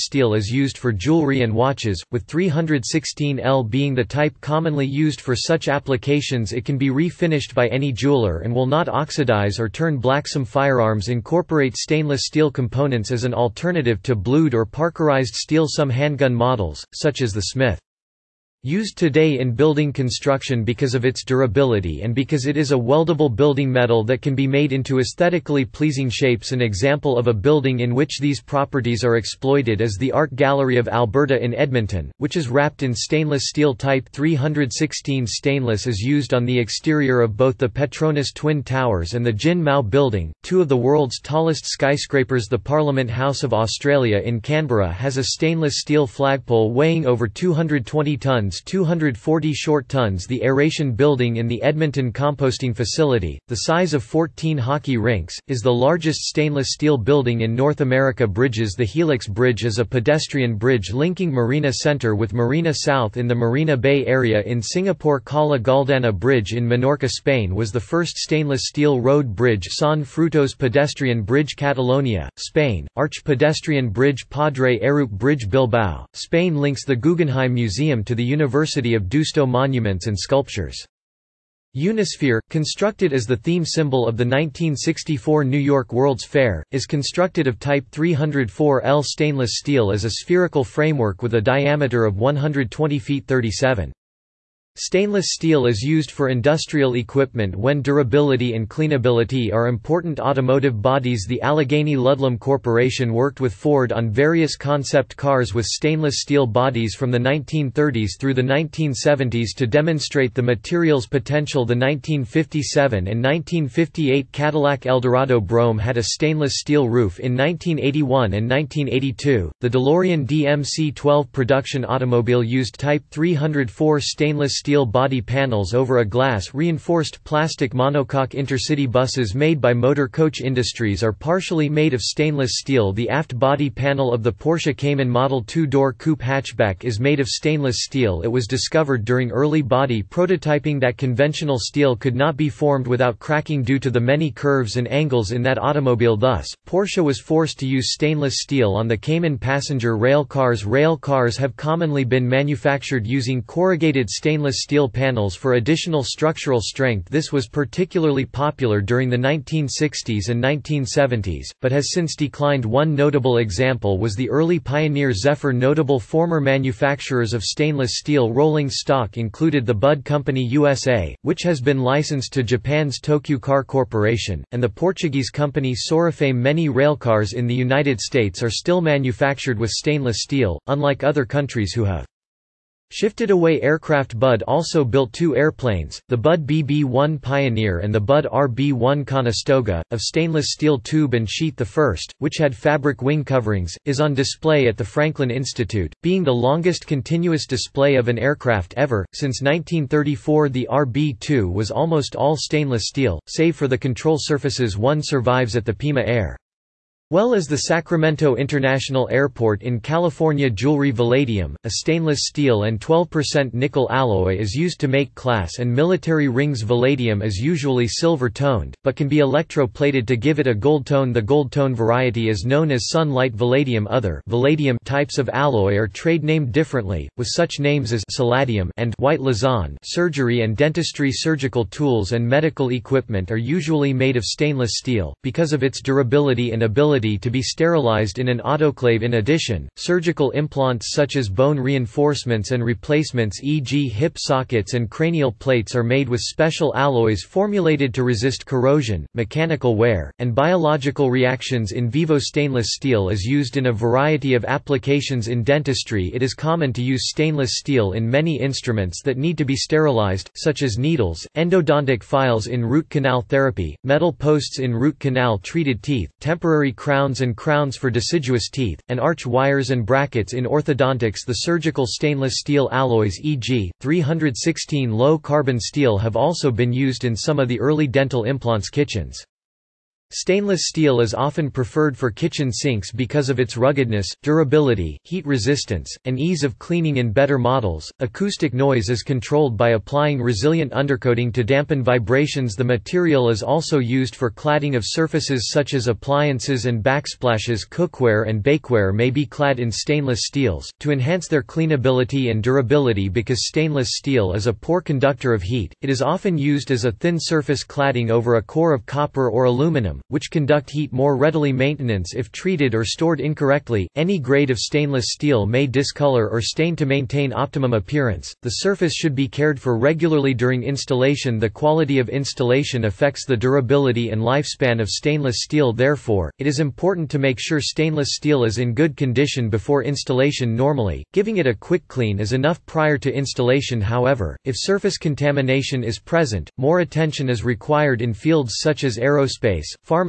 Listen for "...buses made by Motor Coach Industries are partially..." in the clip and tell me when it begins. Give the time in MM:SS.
02:08.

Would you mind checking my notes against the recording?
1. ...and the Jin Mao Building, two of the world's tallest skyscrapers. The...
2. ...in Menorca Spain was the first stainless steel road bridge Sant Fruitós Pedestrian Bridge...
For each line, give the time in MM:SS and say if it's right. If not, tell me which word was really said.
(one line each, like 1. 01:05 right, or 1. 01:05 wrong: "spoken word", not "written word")
1. 00:39 right
2. 01:06 right.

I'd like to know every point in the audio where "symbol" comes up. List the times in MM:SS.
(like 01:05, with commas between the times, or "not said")
01:23.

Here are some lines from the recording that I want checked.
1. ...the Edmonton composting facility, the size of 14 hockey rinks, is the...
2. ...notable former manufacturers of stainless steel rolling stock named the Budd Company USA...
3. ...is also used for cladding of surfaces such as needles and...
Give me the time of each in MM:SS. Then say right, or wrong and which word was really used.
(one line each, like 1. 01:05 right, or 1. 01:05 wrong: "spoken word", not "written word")
1. 00:51 right
2. 02:45 wrong: "included", not "named"
3. 04:53 wrong: "appliances", not "needles".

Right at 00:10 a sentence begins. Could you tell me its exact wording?
Some firearms incorporate stainless steel components as an alternative to blued or parkerized steel.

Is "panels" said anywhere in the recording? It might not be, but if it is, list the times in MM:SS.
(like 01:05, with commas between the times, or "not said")
02:05, 02:13, 02:34.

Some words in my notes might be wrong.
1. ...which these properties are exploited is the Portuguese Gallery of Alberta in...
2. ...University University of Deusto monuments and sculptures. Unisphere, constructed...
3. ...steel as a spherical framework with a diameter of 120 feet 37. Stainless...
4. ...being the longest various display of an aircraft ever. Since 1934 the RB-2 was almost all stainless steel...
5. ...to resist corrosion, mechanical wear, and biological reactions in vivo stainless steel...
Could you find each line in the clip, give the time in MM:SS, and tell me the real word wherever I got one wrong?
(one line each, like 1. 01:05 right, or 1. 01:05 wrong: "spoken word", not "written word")
1. 00:27 wrong: "Art", not "Portuguese"
2. 01:18 right
3. 01:29 right
4. 03:16 wrong: "continuous", not "various"
5. 04:07 right.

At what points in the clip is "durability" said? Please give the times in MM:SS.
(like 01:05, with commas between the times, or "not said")
00:21, 01:37, 03:55, 04:44, 05:02, 05:23.